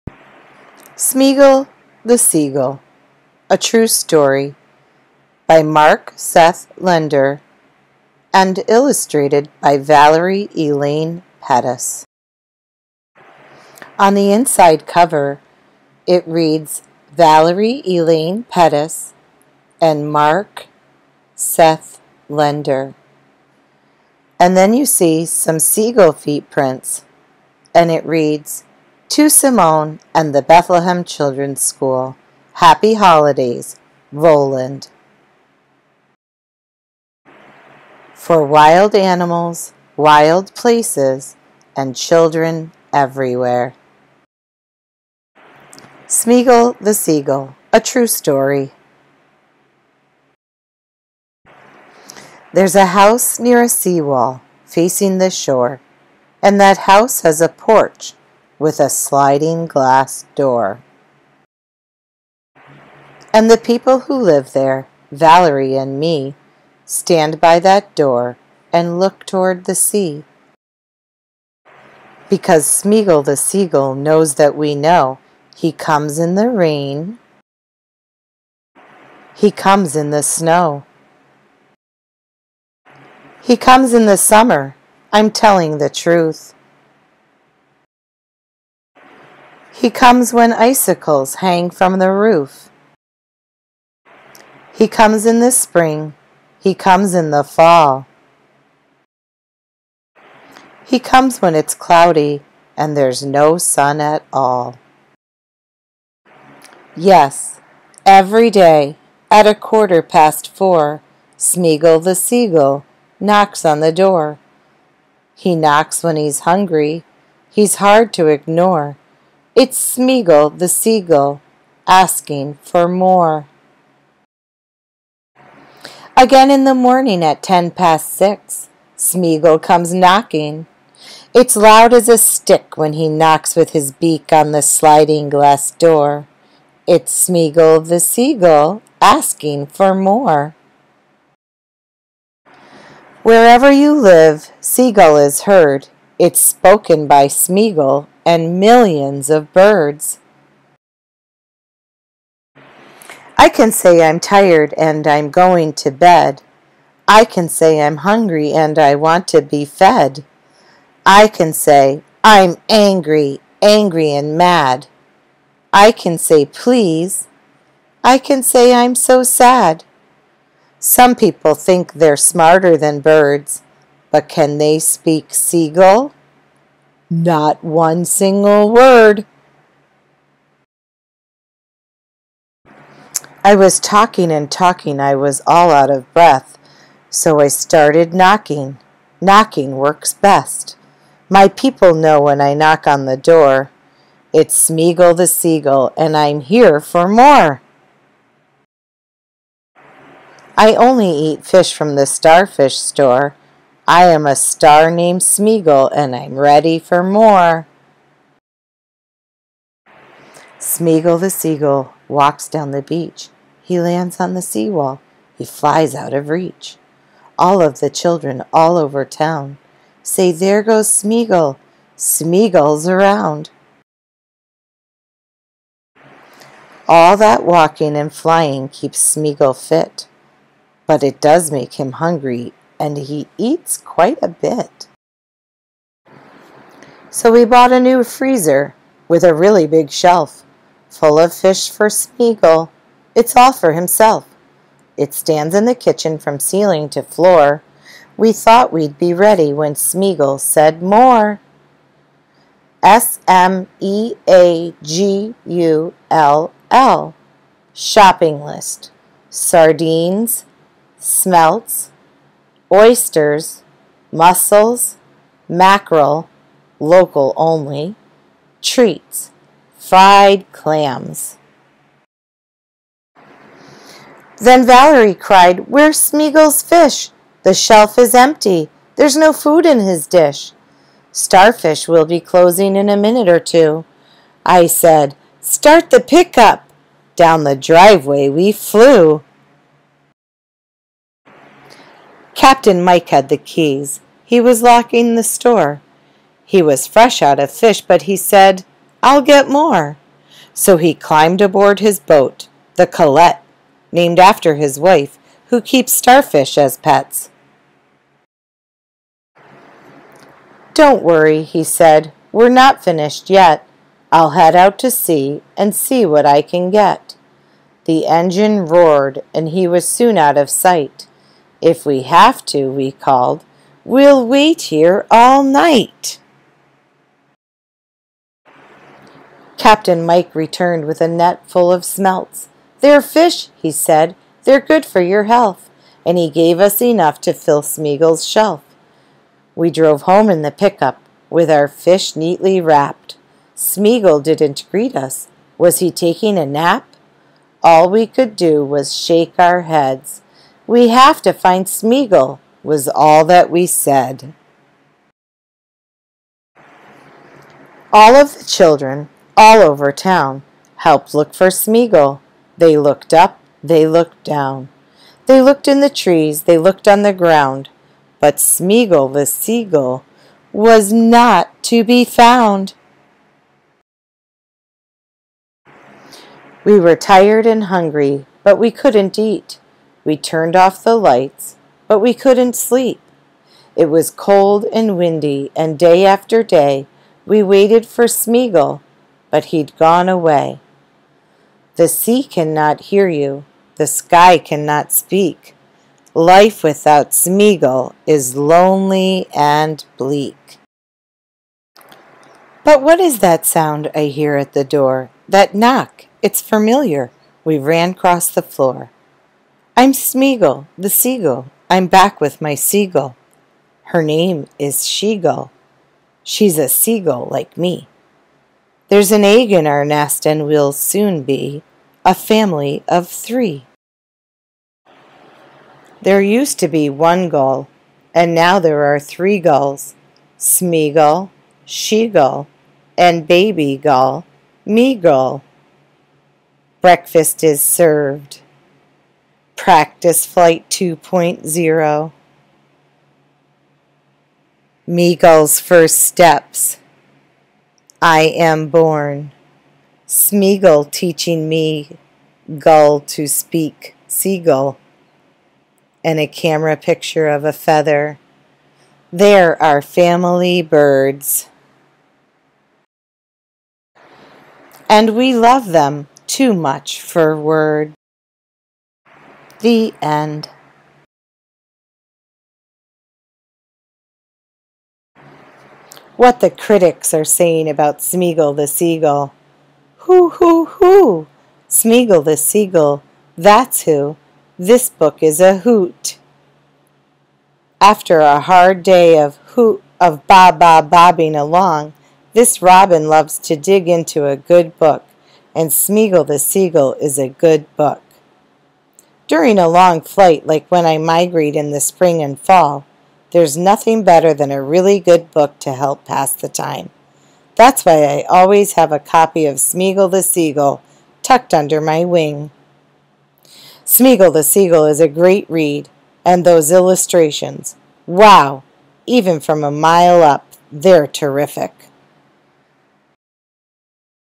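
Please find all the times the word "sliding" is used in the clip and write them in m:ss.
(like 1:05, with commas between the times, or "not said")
0:58, 2:14.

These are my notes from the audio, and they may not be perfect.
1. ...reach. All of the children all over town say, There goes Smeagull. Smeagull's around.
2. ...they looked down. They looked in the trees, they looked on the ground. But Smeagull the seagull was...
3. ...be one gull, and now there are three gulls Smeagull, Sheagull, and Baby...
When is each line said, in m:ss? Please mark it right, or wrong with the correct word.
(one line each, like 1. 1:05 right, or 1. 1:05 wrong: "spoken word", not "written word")
1. 3:36 right
2. 6:03 right
3. 7:06 right.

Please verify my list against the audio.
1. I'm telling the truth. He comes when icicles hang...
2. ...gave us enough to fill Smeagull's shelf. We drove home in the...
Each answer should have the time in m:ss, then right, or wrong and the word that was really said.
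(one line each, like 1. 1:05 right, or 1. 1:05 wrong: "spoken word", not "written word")
1. 1:25 right
2. 5:36 right.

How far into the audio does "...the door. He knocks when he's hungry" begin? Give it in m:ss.
1:53.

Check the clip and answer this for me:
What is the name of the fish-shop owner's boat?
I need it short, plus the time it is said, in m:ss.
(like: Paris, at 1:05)
the Colette, at 5:02.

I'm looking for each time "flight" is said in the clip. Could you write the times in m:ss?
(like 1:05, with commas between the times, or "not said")
7:20, 8:20.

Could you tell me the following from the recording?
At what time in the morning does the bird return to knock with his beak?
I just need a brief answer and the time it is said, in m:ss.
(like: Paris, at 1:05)
ten past six, at 2:07.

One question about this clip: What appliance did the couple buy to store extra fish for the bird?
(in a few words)
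a new freezer.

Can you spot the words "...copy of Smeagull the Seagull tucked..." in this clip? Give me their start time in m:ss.
8:28.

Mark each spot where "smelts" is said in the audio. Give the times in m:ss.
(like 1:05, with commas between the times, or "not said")
4:20, 5:31.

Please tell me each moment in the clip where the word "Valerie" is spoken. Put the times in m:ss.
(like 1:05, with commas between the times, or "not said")
0:09, 0:17, 1:05, 4:34.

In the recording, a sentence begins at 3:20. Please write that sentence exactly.
I only eat fish from the starfish store.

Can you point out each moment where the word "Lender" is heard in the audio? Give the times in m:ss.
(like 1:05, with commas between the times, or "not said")
0:06, 0:22.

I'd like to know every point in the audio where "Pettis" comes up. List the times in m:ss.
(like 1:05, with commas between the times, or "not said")
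0:11, 0:18.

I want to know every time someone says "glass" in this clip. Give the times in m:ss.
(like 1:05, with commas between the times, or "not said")
0:59, 2:15.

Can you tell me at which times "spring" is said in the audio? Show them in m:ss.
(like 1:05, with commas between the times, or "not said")
1:35, 8:21.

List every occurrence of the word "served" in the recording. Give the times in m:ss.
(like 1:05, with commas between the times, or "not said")
7:17.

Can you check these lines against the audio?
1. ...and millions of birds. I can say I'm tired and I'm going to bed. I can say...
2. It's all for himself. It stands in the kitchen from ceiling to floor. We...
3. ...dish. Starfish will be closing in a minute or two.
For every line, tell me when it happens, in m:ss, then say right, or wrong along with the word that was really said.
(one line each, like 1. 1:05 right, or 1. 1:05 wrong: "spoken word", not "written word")
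1. 2:28 right
2. 4:03 right
3. 4:40 right.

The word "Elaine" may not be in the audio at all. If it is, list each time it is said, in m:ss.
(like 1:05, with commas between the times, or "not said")
0:10, 0:17.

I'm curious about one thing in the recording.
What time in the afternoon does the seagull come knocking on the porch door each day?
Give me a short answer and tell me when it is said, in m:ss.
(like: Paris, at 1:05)
quarter past four, at 1:49.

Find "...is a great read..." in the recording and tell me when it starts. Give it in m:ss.
8:34.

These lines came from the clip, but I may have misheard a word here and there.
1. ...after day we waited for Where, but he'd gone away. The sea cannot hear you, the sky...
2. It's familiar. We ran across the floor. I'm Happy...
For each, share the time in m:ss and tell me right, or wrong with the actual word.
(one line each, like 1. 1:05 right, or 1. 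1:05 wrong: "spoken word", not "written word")
1. 6:26 wrong: "Smeagull", not "Where"
2. 6:46 wrong: "Smeagull", not "Happy".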